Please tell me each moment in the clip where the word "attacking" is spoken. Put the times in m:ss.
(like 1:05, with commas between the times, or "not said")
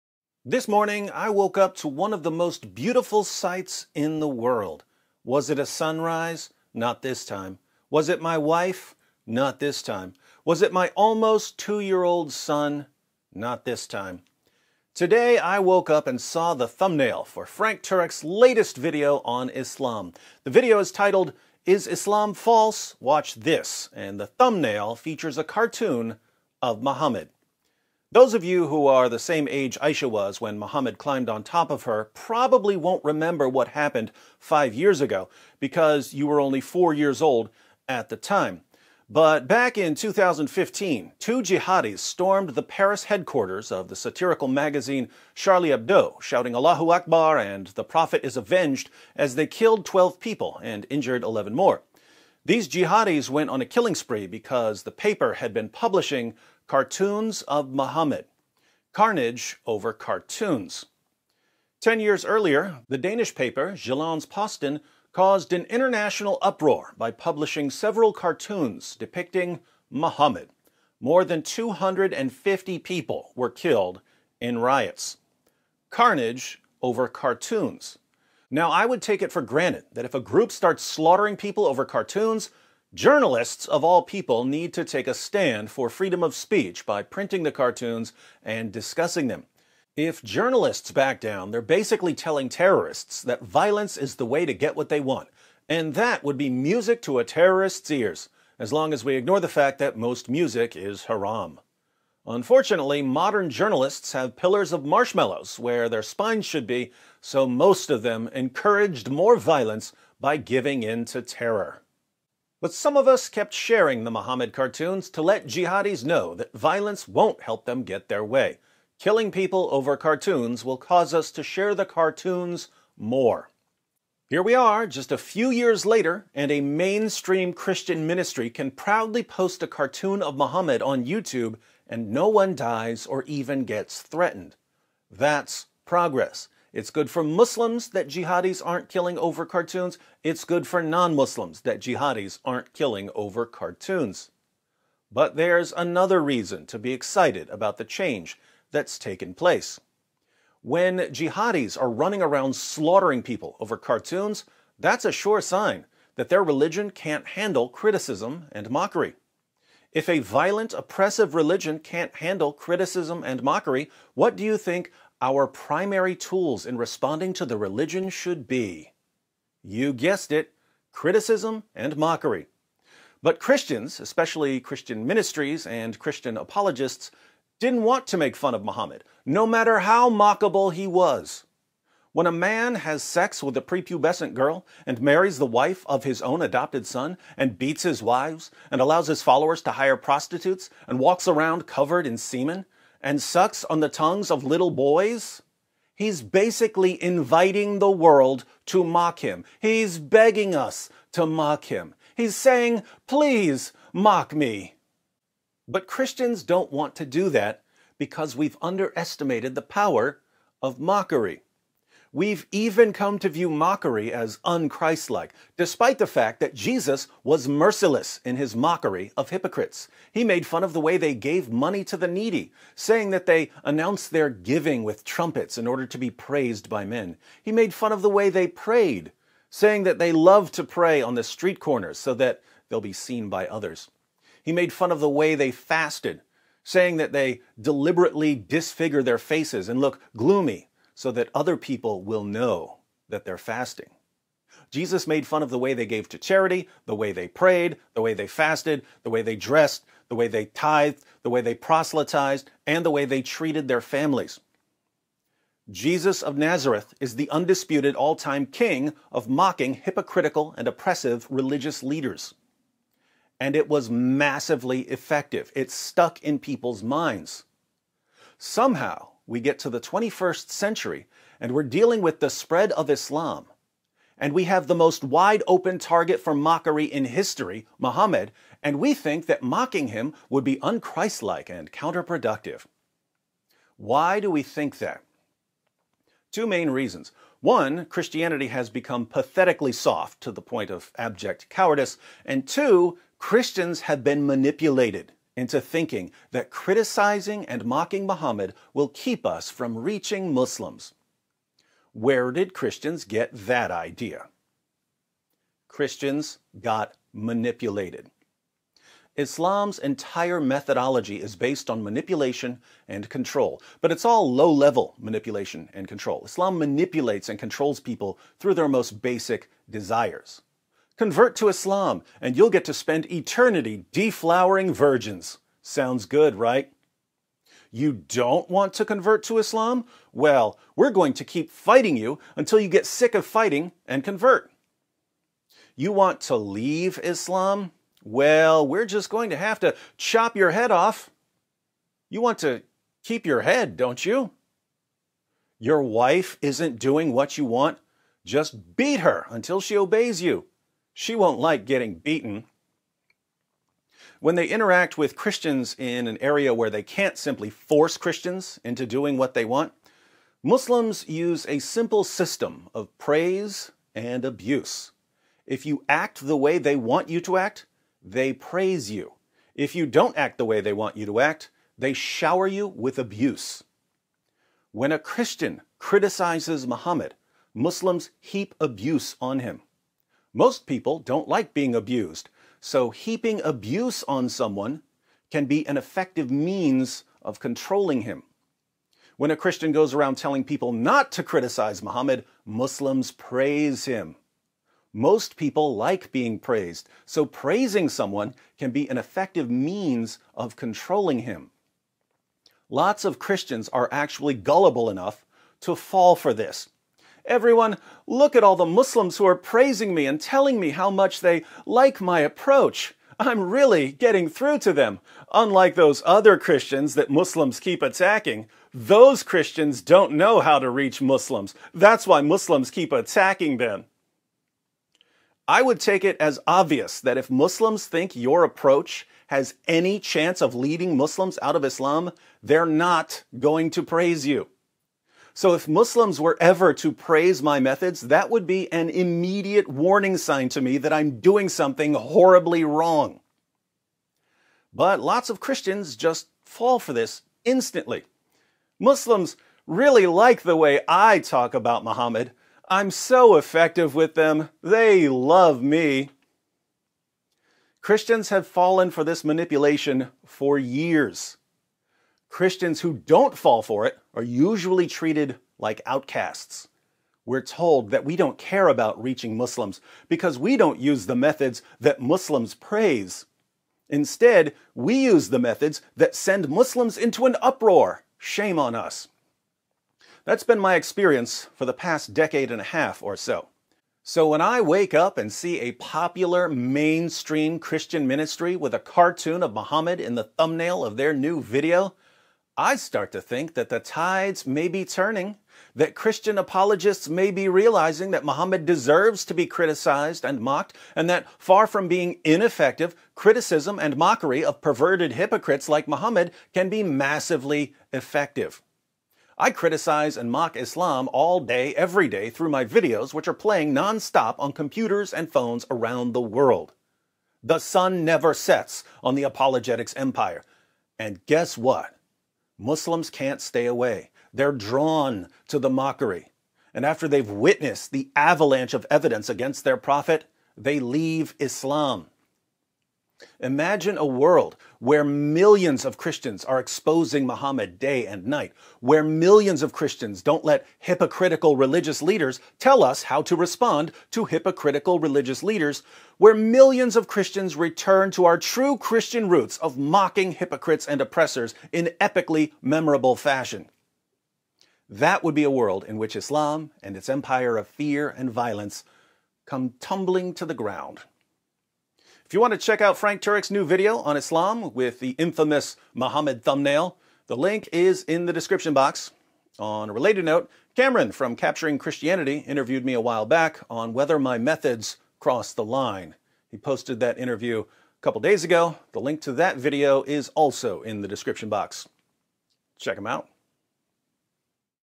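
6:57, 7:02.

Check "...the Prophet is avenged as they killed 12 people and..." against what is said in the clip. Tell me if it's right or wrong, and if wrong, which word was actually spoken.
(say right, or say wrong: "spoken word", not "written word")
right.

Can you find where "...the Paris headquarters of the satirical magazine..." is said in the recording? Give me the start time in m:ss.
0:42.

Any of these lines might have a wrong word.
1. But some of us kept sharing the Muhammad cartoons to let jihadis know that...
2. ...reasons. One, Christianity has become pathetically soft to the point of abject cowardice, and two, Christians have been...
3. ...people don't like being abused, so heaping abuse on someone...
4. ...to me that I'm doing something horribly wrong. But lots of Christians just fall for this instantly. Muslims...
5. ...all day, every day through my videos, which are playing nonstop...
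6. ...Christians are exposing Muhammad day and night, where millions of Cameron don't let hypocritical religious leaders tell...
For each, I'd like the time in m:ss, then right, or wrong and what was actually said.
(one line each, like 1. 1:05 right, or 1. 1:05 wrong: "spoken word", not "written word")
1. 1:52 right
2. 4:46 right
3. 6:20 right
4. 7:20 right
5. 8:31 right
6. 8:55 wrong: "Christians", not "Cameron".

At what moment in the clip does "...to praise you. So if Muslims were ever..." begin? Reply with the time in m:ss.
7:13.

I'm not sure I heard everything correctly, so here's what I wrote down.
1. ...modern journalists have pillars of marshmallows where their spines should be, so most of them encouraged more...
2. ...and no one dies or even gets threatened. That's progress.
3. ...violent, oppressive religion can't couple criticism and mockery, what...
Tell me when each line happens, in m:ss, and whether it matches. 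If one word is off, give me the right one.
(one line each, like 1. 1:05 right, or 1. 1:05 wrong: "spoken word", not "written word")
1. 1:43 right
2. 2:11 right
3. 2:40 wrong: "handle", not "couple".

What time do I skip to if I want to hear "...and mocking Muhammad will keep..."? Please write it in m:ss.
4:57.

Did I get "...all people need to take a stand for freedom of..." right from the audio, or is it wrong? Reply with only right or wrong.
right.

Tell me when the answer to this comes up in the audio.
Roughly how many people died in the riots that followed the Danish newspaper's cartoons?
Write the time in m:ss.
1:10.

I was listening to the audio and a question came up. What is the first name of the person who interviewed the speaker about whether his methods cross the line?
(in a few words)
Cameron.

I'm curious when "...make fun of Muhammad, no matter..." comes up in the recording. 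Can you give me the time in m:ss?
2:58.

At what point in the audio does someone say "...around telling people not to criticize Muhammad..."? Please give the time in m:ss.
6:29.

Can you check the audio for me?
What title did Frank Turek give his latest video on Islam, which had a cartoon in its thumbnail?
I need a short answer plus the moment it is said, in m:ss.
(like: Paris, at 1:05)
Is Islam False? Watch This, at 0:21.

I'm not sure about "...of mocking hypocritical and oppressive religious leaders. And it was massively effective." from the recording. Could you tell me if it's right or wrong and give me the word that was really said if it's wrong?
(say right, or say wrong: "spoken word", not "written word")
right.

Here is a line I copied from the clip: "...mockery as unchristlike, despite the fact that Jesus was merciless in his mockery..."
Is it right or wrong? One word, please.
right.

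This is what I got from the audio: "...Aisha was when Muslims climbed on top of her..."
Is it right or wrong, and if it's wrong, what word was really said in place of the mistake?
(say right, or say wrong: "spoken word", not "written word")
wrong: "Muhammad", not "Muslims".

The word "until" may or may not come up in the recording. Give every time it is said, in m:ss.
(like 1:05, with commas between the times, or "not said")
5:32, 5:49.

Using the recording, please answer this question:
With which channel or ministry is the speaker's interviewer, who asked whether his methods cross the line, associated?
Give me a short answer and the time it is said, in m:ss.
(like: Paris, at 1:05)
Capturing Christianity, at 9:31.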